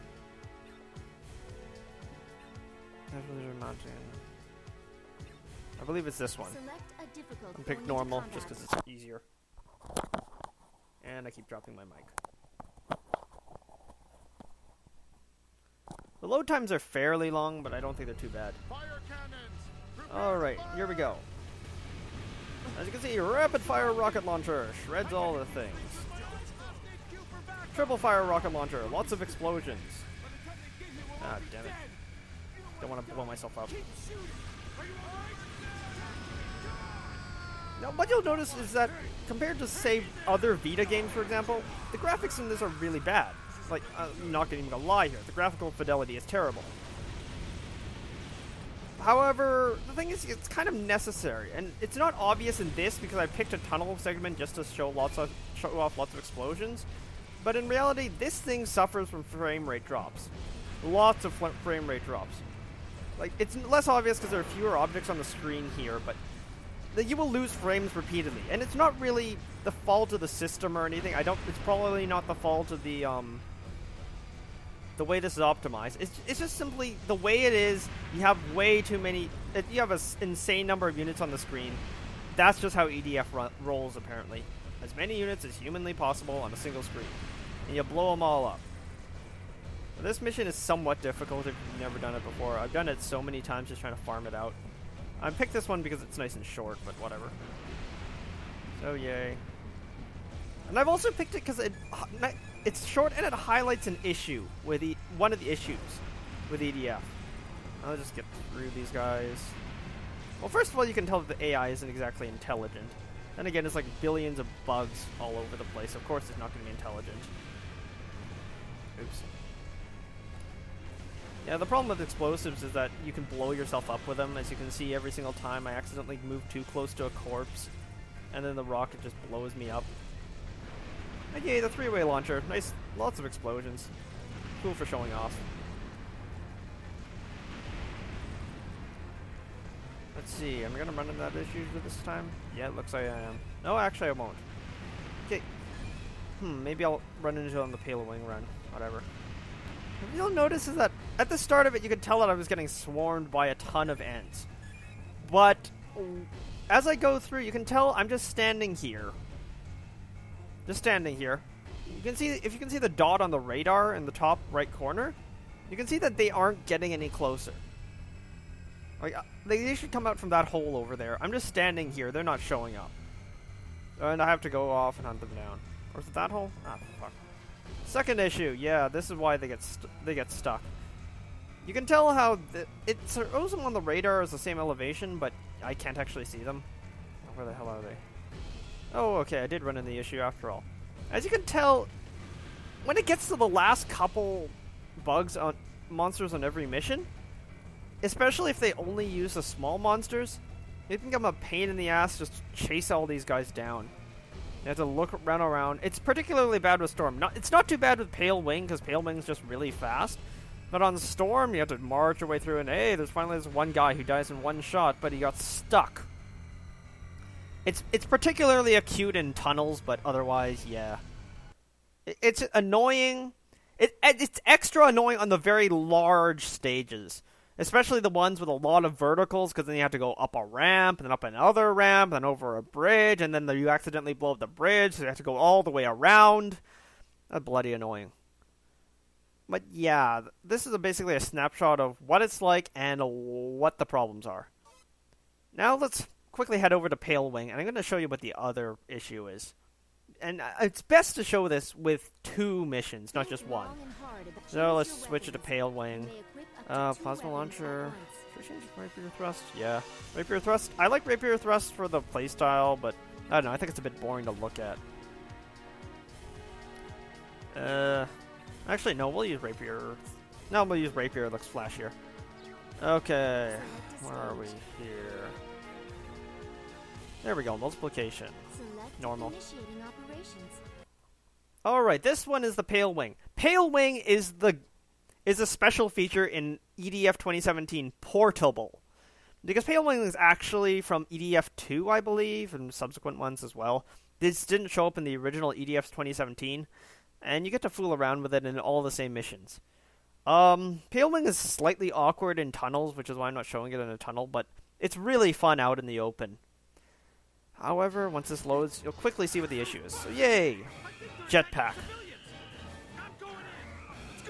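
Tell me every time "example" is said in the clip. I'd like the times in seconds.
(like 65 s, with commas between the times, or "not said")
41 s.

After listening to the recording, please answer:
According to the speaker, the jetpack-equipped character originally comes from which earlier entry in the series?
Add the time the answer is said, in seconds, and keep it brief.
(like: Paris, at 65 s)
EDF 2, at 291 s.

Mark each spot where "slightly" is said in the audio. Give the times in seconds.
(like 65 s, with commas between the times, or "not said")
301 s.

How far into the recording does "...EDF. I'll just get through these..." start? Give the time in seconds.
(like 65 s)
106 s.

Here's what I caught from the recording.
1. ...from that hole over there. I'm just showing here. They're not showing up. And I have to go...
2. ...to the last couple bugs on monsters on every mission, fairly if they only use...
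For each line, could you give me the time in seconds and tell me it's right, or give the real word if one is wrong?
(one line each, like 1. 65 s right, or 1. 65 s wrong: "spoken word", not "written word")
1. 170 s wrong: "standing", not "showing"
2. 193 s wrong: "especially", not "fairly".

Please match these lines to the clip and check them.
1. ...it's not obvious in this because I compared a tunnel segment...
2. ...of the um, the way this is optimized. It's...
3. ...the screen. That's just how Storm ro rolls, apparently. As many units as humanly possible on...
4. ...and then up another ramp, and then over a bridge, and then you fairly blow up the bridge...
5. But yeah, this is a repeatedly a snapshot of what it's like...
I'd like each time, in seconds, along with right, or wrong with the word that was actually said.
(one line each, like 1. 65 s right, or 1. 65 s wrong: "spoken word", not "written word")
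1. 51 s wrong: "picked", not "compared"
2. 72 s right
3. 81 s wrong: "EDF", not "Storm"
4. 231 s wrong: "accidentally", not "fairly"
5. 239 s wrong: "basically", not "repeatedly".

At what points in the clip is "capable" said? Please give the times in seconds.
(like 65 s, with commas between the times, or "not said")
not said.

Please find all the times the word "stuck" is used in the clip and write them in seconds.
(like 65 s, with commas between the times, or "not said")
180 s, 215 s.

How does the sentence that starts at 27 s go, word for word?
Triple fire rocket launcher, lots of explosions.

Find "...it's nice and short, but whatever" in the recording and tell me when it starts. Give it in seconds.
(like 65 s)
96 s.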